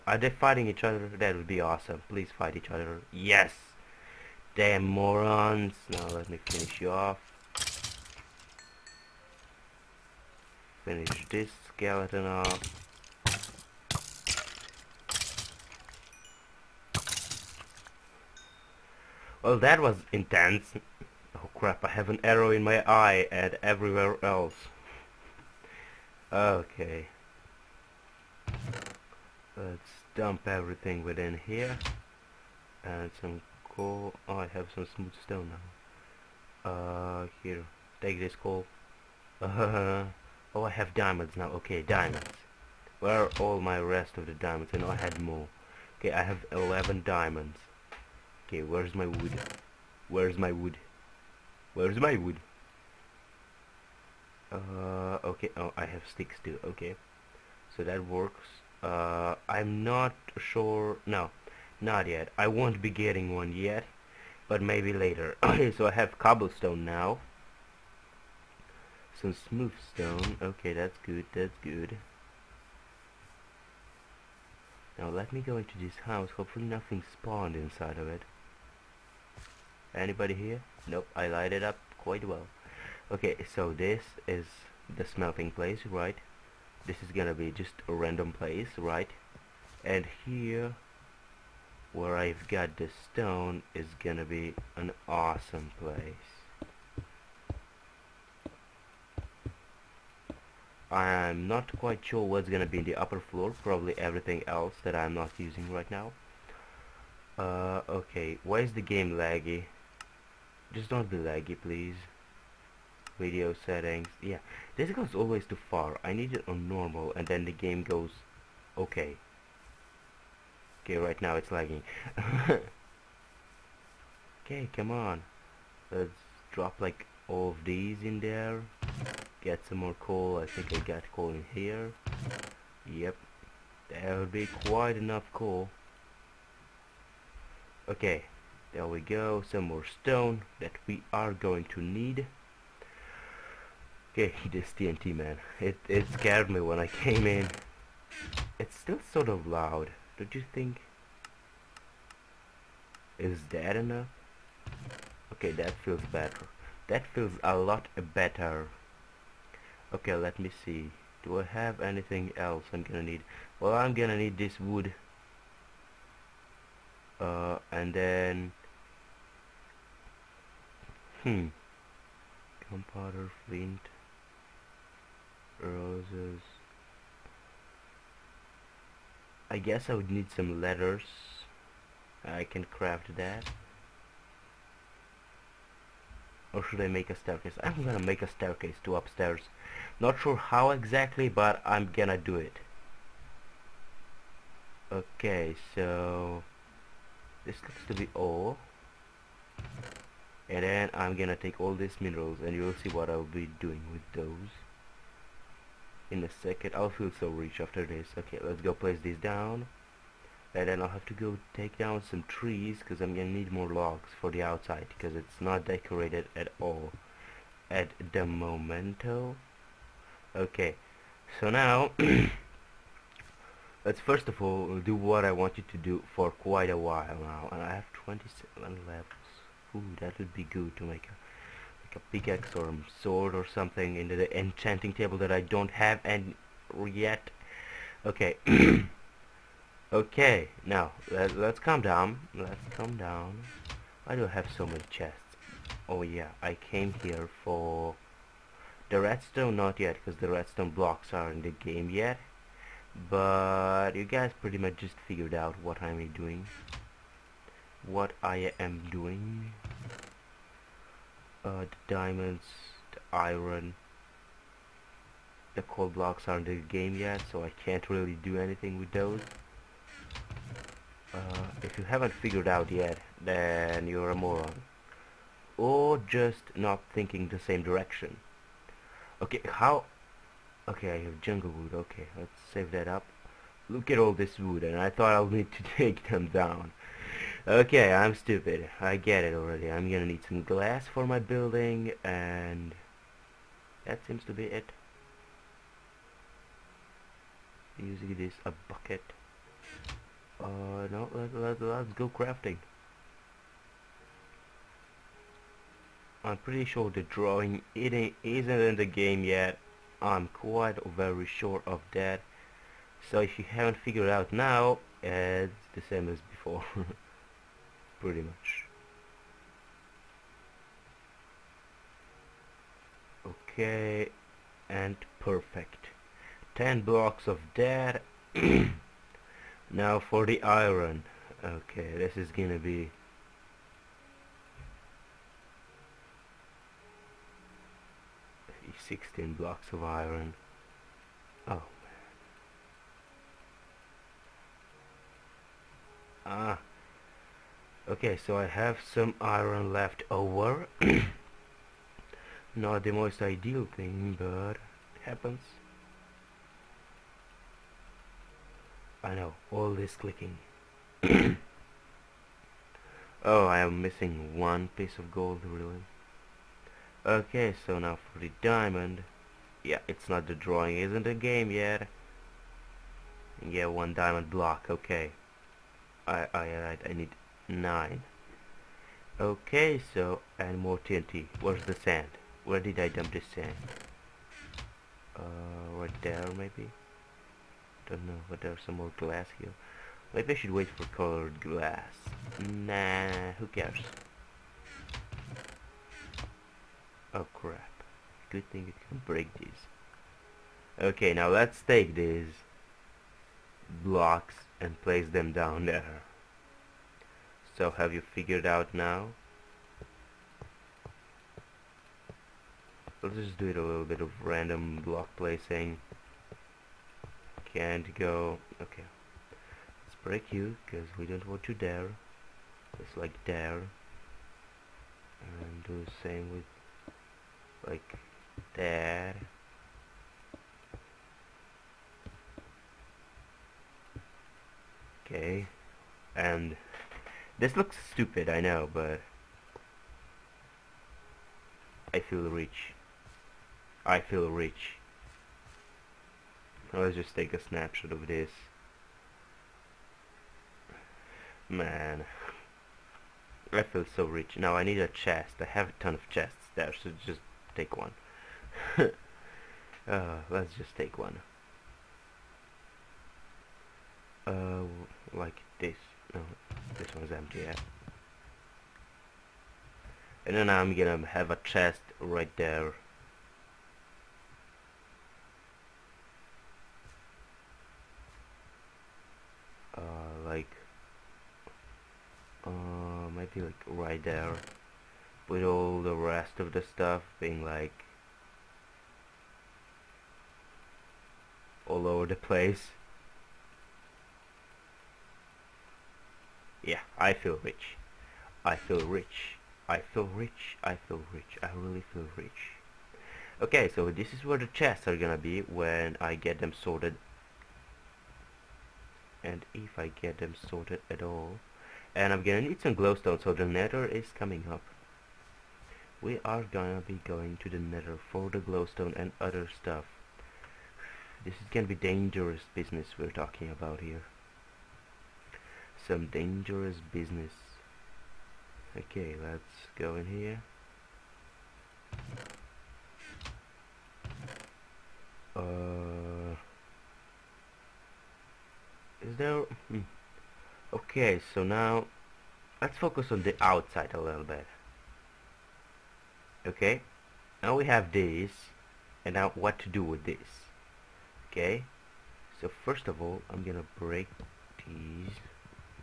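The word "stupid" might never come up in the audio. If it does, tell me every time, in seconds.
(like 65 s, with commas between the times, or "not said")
288 s, 437 s.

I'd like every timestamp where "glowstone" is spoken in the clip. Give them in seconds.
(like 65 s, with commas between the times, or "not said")
512 s, 518 s.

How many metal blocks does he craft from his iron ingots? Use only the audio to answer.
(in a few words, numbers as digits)
16.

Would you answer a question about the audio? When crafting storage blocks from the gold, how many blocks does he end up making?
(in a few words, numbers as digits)
10.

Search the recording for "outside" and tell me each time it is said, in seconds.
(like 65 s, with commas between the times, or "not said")
214 s, 543 s.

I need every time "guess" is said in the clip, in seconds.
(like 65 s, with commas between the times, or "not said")
179 s.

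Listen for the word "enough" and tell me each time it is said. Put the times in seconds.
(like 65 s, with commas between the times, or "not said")
134 s, 153 s.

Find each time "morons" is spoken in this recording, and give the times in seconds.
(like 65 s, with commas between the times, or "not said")
4 s, 274 s.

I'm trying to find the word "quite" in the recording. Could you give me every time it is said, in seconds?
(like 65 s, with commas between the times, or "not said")
81 s, 101 s, 134 s, 226 s, 310 s.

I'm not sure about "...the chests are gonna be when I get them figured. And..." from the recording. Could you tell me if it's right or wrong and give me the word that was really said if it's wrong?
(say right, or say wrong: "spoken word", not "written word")
wrong: "sorted", not "figured".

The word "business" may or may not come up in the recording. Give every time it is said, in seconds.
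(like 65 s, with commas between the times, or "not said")
522 s, 526 s.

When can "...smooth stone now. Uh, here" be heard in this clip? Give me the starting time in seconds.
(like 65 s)
34 s.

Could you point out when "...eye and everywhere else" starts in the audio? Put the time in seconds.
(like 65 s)
22 s.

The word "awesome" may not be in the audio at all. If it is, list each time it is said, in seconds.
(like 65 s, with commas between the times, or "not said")
1 s, 95 s.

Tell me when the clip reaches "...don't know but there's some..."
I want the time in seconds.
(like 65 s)
387 s.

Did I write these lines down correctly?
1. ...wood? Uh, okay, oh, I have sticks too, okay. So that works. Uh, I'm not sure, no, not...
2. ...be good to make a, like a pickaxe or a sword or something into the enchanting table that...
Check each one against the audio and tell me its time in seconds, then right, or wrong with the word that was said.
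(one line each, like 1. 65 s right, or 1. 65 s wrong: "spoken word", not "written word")
1. 52 s right
2. 230 s right.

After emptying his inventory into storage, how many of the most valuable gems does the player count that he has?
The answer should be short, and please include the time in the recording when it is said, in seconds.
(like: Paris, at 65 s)
11, at 46 s.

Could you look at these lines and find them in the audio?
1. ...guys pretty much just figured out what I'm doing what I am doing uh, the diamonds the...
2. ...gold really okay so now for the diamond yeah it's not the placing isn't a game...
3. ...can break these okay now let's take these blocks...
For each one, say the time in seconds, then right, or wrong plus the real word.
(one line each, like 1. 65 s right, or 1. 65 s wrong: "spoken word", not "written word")
1. 254 s right
2. 365 s wrong: "drawing", not "placing"
3. 398 s right.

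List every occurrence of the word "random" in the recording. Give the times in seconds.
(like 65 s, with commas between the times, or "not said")
87 s, 414 s.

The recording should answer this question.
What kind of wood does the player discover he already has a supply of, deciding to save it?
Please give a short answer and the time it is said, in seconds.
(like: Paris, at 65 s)
Jungle wood, at 281 s.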